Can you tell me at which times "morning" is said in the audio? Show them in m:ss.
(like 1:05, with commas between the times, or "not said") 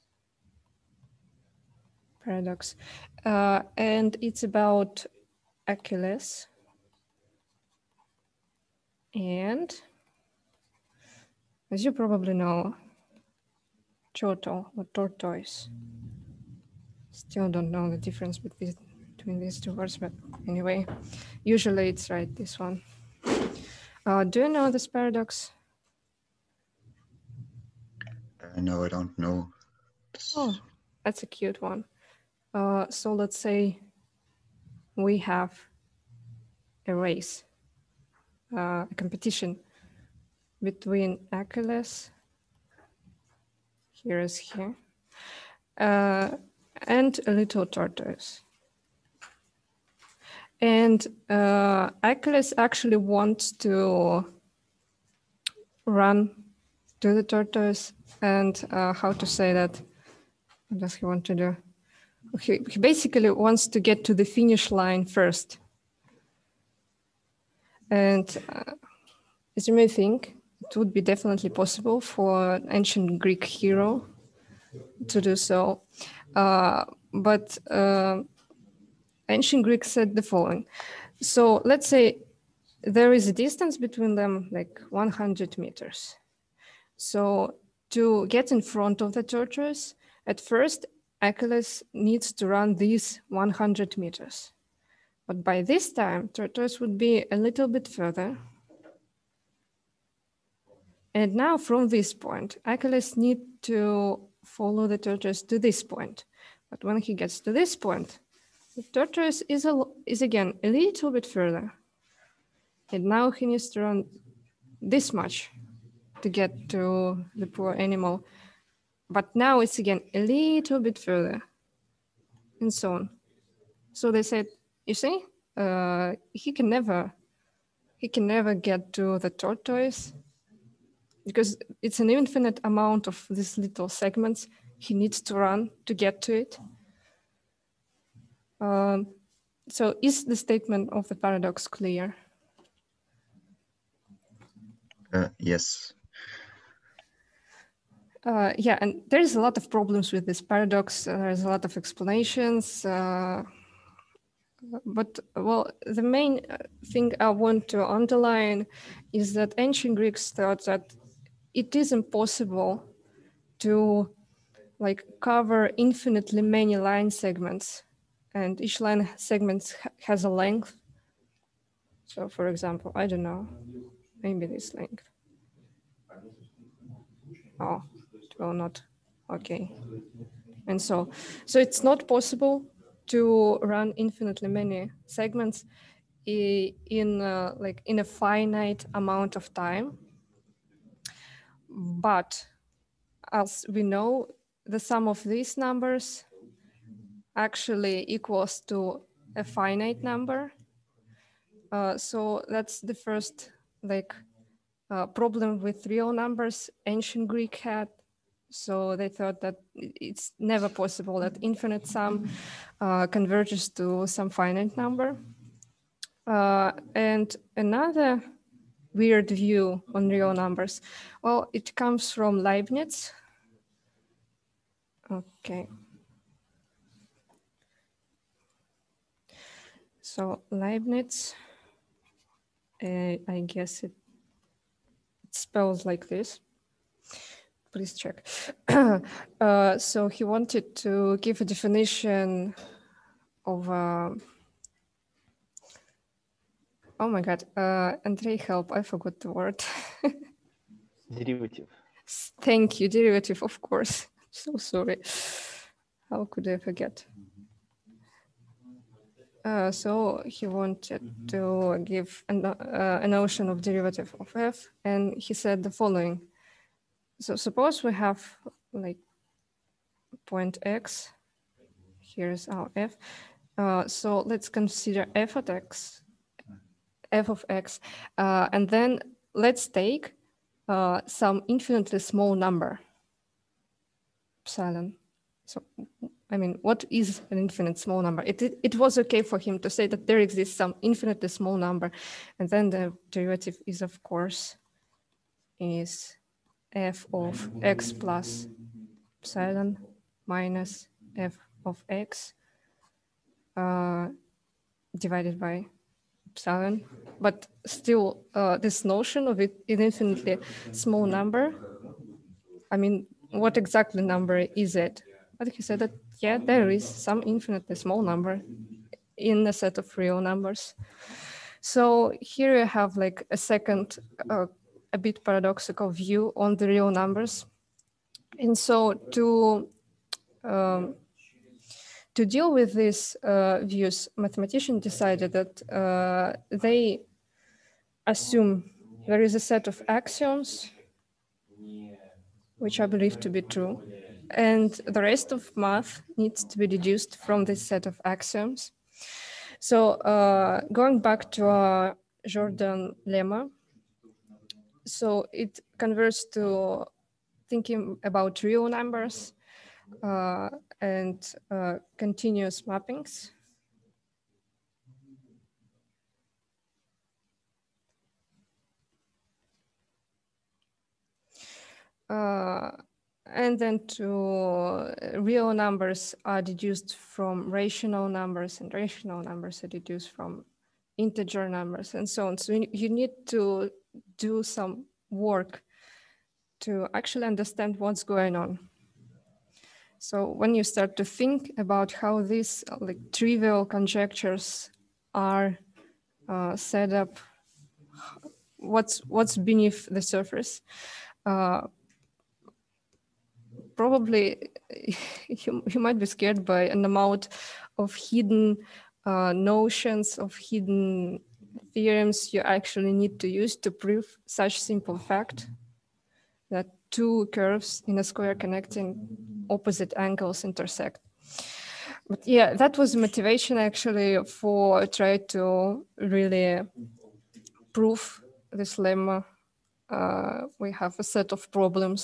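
not said.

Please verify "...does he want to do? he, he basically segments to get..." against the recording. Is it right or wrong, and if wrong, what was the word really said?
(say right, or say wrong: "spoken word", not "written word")
wrong: "wants", not "segments".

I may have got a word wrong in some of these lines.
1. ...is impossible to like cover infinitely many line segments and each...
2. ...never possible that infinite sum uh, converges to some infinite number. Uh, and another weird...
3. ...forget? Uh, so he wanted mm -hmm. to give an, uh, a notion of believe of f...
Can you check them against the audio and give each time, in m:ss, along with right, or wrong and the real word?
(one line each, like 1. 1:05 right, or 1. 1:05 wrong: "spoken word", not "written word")
1. 2:41 right
2. 3:30 wrong: "finite", not "infinite"
3. 4:16 wrong: "derivative", not "believe".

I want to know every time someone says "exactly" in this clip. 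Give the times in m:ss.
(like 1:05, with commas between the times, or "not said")
5:13.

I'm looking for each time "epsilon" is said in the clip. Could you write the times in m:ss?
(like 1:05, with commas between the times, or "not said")
4:44, 4:59, 5:06.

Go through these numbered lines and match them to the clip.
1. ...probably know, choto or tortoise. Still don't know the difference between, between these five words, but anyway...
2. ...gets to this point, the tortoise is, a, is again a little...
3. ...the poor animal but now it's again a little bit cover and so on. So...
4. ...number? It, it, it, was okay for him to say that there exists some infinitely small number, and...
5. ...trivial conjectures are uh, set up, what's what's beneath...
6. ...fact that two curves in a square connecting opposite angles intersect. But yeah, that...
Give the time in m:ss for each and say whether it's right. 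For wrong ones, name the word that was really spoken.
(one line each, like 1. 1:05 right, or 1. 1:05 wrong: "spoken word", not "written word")
1. 0:11 wrong: "two", not "five"
2. 1:47 right
3. 1:57 wrong: "further", not "cover"
4. 4:48 right
5. 6:33 right
6. 6:54 right.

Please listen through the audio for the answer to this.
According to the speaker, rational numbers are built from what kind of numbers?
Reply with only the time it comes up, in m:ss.
6:20.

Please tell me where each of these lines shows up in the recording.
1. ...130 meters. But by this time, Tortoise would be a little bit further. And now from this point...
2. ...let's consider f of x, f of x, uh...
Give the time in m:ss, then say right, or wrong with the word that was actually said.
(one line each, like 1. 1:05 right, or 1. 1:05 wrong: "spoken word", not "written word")
1. 1:33 wrong: "100", not "130"
2. 4:34 right.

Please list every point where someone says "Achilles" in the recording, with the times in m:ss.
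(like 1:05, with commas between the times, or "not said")
0:05, 0:41, 0:52, 1:31, 1:42.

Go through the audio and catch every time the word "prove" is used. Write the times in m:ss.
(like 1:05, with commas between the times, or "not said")
6:53, 7:07.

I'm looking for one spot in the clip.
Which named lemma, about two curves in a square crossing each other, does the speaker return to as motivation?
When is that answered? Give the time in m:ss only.
5:52.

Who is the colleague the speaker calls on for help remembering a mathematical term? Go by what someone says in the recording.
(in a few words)
Andrei.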